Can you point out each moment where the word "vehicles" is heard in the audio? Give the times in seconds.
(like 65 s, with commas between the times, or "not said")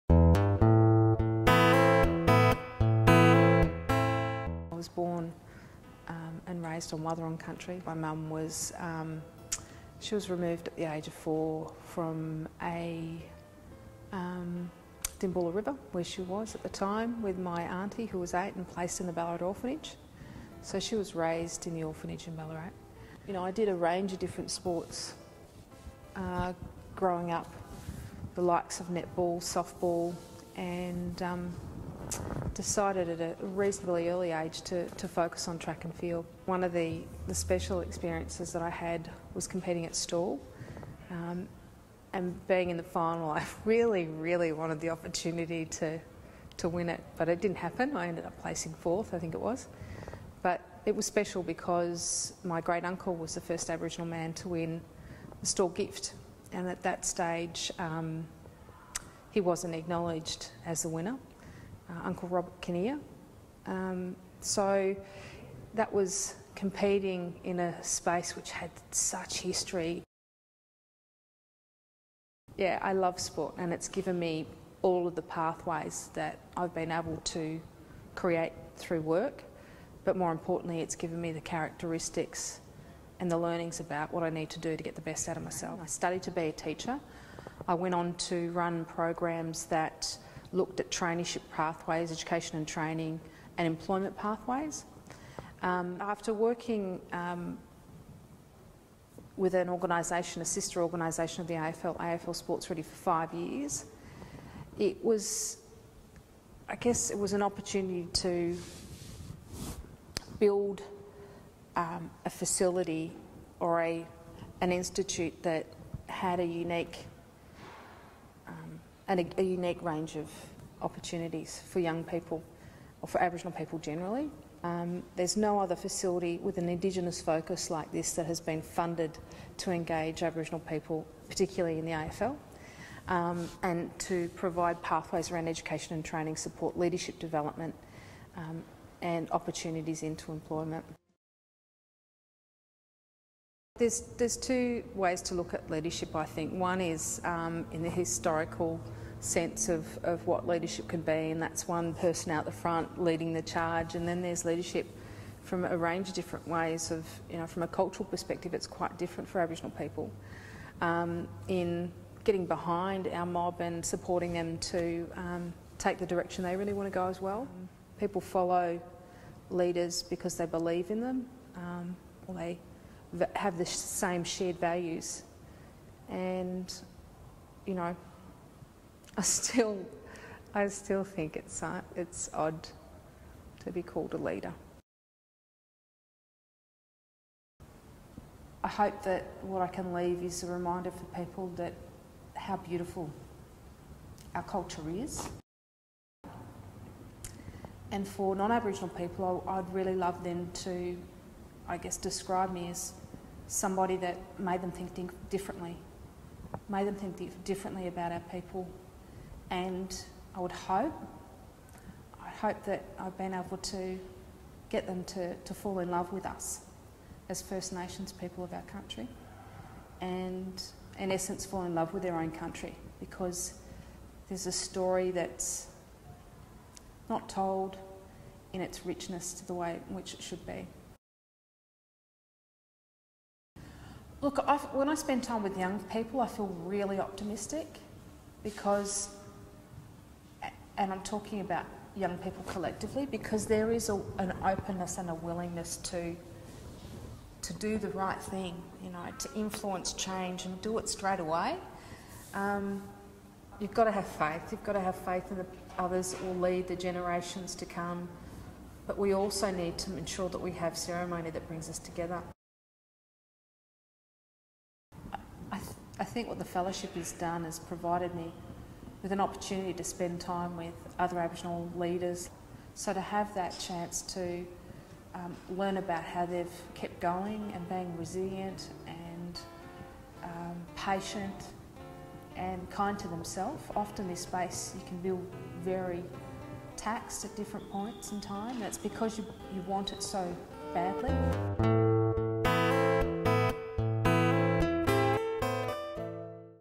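not said.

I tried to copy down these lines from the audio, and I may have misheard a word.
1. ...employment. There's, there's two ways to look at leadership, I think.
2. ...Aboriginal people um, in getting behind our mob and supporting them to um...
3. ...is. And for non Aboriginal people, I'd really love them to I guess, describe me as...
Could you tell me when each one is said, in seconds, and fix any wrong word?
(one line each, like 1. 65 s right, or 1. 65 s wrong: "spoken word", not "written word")
1. 140 s right
2. 159 s right
3. 194 s right.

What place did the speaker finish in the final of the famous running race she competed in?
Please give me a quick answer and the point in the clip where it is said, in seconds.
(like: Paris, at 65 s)
4th, at 48 s.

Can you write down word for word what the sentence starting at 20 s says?
So she was raised in the orphanage in Ballarat.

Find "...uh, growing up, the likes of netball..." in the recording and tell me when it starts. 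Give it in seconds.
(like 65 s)
26 s.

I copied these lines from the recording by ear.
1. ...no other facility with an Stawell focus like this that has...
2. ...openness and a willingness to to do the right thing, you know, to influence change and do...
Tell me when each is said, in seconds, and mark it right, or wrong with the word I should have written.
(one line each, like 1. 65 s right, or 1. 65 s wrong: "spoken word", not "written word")
1. 125 s wrong: "Indigenous", not "Stawell"
2. 244 s right.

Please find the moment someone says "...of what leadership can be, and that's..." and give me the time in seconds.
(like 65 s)
150 s.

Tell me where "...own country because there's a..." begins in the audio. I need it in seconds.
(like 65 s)
222 s.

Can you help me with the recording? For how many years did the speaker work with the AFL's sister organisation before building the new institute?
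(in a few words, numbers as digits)
5.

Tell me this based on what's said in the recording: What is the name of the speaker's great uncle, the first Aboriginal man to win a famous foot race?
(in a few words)
Robert Kinnear.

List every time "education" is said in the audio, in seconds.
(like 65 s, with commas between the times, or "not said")
92 s, 135 s.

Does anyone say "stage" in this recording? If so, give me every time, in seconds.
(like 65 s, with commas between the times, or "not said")
57 s.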